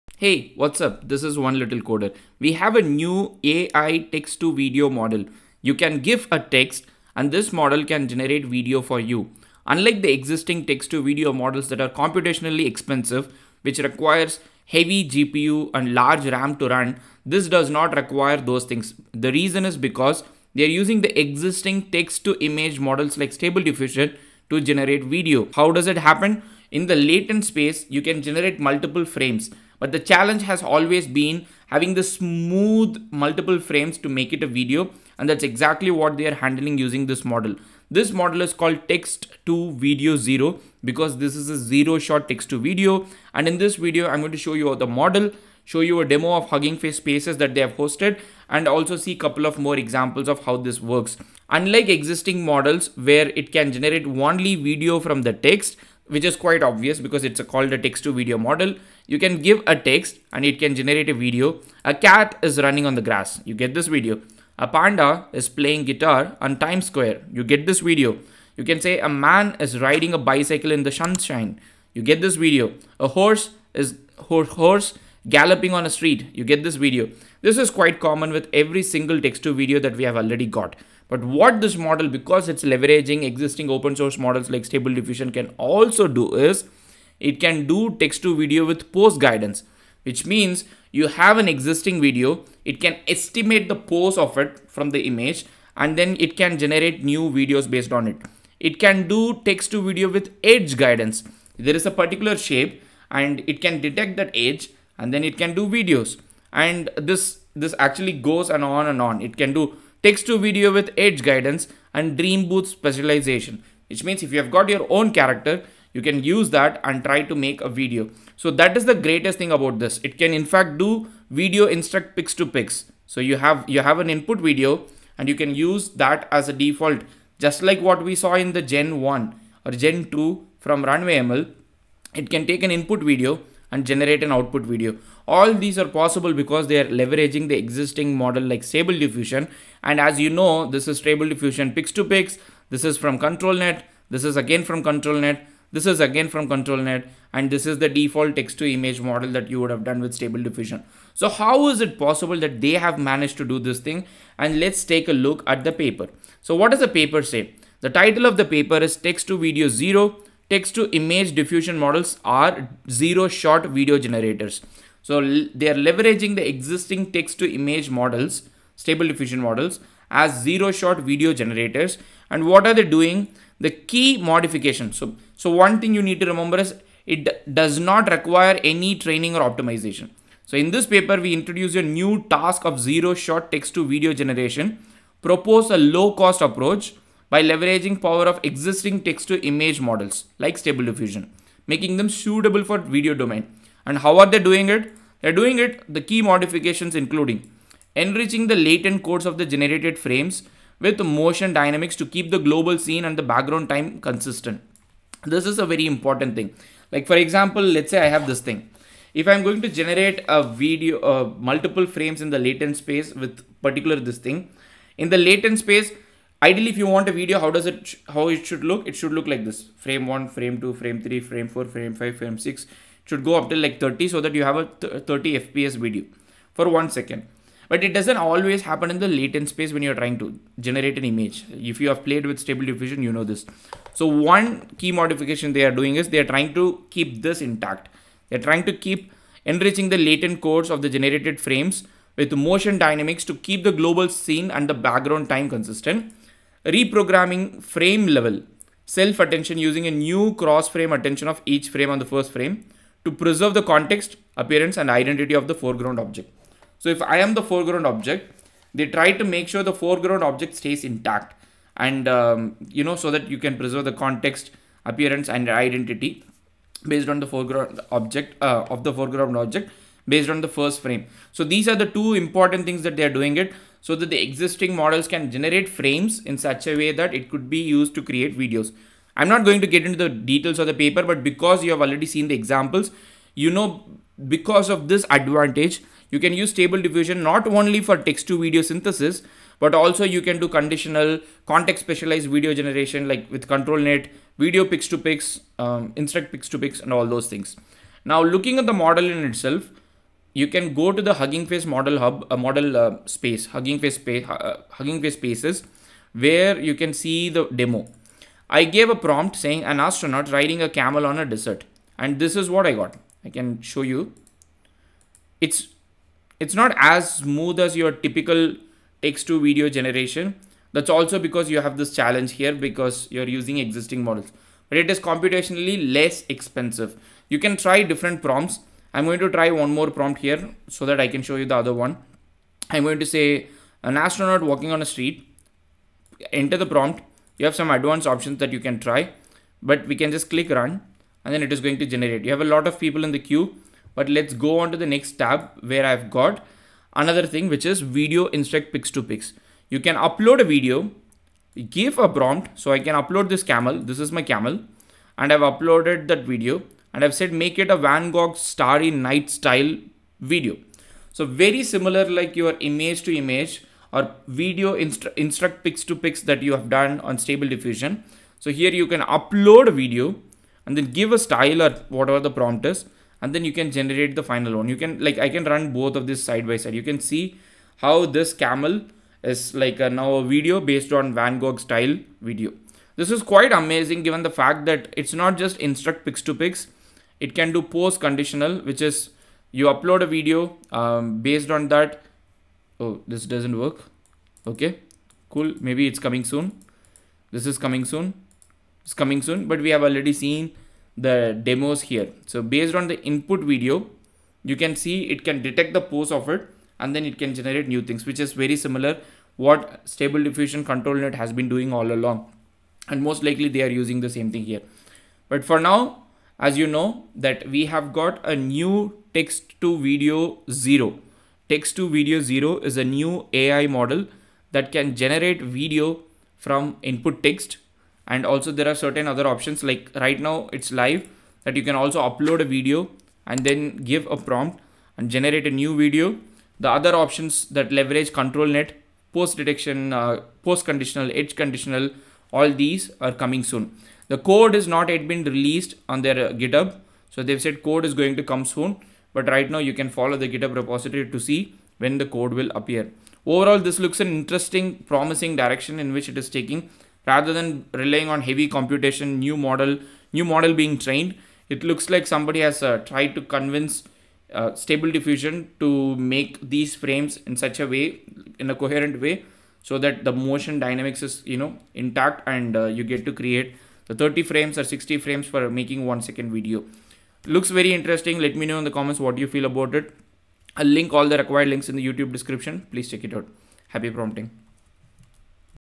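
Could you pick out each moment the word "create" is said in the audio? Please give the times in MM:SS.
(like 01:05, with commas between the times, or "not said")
04:38, 07:53.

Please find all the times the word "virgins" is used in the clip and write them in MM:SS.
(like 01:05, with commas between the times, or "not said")
not said.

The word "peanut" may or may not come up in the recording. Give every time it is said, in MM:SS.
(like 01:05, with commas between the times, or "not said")
not said.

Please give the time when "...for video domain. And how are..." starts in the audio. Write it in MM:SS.
03:12.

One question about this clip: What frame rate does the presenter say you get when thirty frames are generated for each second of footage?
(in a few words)
30 fps.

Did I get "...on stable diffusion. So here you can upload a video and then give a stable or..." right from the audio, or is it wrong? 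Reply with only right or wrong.
wrong.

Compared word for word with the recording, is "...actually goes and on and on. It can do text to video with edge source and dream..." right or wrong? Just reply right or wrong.
wrong.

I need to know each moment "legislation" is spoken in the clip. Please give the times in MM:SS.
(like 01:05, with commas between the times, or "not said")
not said.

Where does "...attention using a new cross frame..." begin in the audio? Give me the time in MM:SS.
04:09.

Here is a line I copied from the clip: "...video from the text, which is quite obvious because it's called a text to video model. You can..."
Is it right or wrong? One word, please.
right.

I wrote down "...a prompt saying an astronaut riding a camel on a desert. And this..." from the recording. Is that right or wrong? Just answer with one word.
right.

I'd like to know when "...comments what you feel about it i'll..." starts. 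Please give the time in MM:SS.
07:58.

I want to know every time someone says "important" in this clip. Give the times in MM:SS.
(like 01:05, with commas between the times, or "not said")
03:25, 04:32.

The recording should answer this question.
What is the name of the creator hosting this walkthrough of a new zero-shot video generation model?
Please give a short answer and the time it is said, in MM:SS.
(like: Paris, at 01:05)
One Little Coder, at 00:01.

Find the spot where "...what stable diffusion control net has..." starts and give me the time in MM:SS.
06:49.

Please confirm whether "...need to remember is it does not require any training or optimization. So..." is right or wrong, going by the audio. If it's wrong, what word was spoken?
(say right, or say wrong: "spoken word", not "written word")
right.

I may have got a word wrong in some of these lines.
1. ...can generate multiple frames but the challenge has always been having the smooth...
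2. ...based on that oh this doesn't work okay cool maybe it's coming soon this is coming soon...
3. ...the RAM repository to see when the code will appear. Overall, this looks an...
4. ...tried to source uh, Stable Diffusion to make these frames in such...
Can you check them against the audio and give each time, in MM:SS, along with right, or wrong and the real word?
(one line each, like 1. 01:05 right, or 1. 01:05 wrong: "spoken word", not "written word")
1. 00:28 right
2. 06:31 right
3. 07:30 wrong: "GitHub", not "RAM"
4. 07:42 wrong: "convince", not "source".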